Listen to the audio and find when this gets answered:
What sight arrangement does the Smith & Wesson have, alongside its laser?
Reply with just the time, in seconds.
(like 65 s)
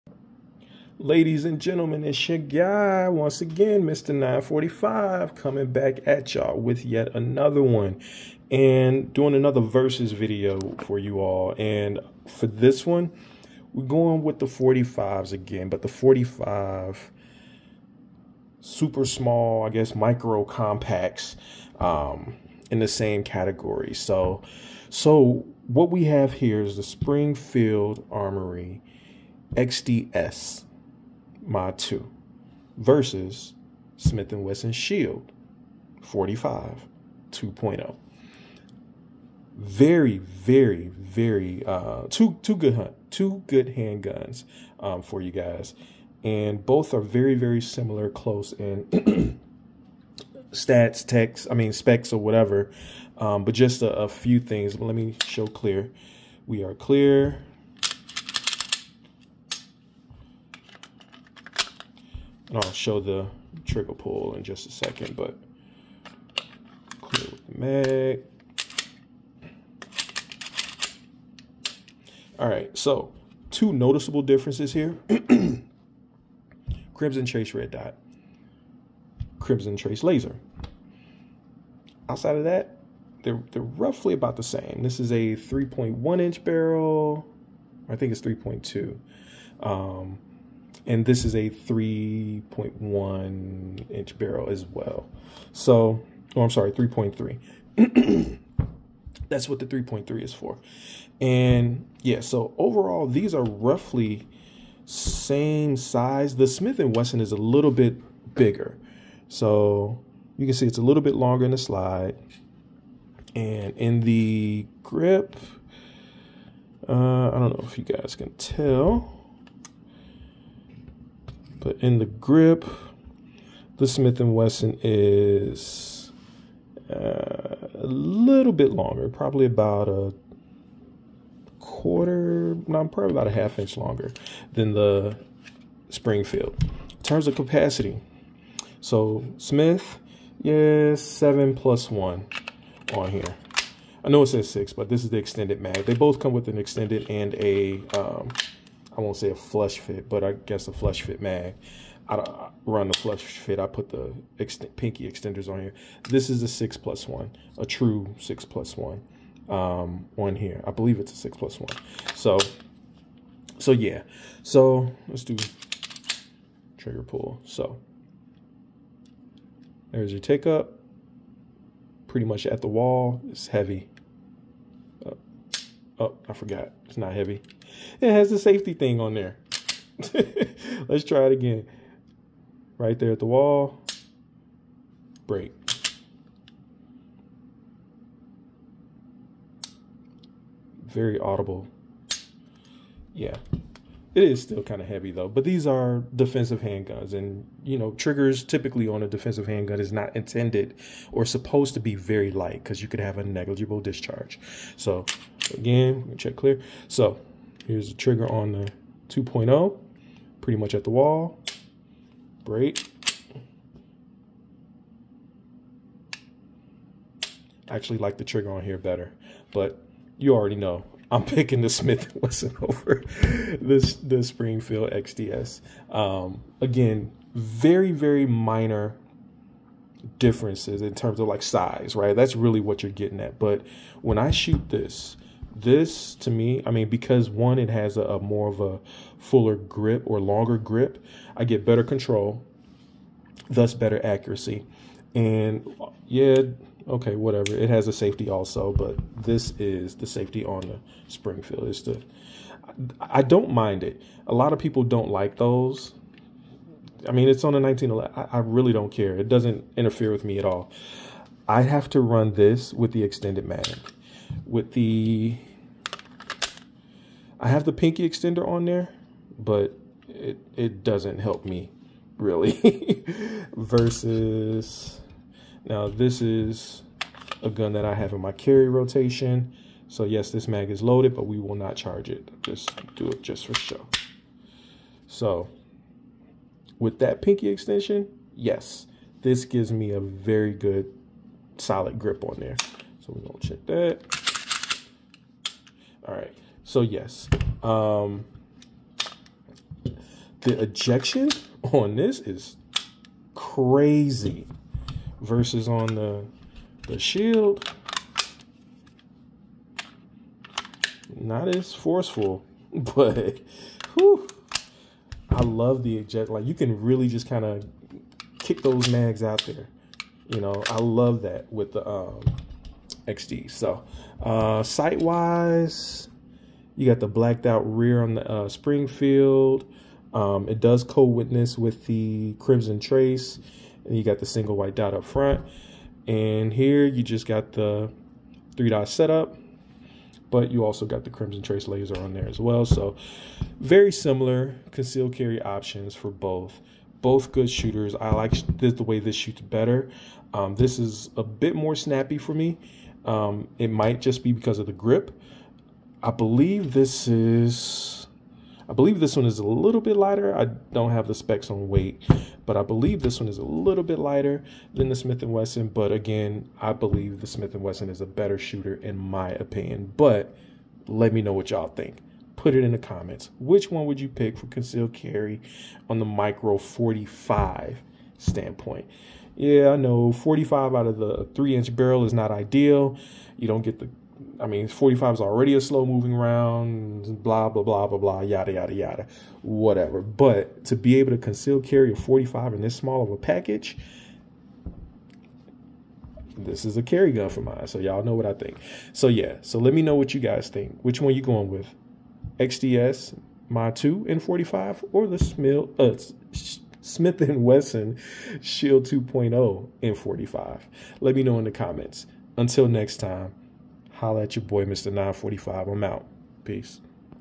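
338 s.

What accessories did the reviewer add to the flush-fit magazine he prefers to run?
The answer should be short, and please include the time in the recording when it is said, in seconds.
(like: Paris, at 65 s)
pinky extenders, at 154 s.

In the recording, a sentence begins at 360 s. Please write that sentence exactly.
I don't have the specs on weight, but I believe this one is a little bit lighter than the Smith & Wesson.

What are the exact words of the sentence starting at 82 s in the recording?
Outside of that, they're, they're roughly about the same.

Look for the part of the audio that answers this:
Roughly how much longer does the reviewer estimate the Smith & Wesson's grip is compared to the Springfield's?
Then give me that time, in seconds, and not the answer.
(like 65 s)
133 s.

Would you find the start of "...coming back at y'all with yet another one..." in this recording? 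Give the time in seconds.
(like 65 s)
5 s.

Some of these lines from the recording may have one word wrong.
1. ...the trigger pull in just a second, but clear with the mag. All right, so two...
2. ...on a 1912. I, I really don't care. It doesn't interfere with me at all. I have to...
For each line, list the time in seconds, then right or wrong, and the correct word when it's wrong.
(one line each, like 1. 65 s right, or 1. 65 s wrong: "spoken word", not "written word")
1. 62 s right
2. 257 s wrong: "1911", not "1912".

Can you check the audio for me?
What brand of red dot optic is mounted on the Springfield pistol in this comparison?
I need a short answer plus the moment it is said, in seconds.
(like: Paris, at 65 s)
Crimson Trace Red Dot, at 76 s.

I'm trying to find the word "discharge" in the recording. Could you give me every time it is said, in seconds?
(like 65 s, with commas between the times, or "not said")
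203 s.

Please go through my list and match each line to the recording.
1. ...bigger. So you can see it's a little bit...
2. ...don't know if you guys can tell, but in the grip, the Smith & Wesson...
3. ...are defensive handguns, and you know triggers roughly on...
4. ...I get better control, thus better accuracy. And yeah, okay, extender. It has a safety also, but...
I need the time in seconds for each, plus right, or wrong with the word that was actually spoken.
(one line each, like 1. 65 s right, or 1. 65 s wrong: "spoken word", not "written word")
1. 108 s right
2. 117 s right
3. 195 s wrong: "typically", not "roughly"
4. 241 s wrong: "whatever", not "extender".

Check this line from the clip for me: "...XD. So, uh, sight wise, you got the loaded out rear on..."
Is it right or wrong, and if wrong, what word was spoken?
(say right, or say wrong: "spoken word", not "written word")
wrong: "blacked", not "loaded".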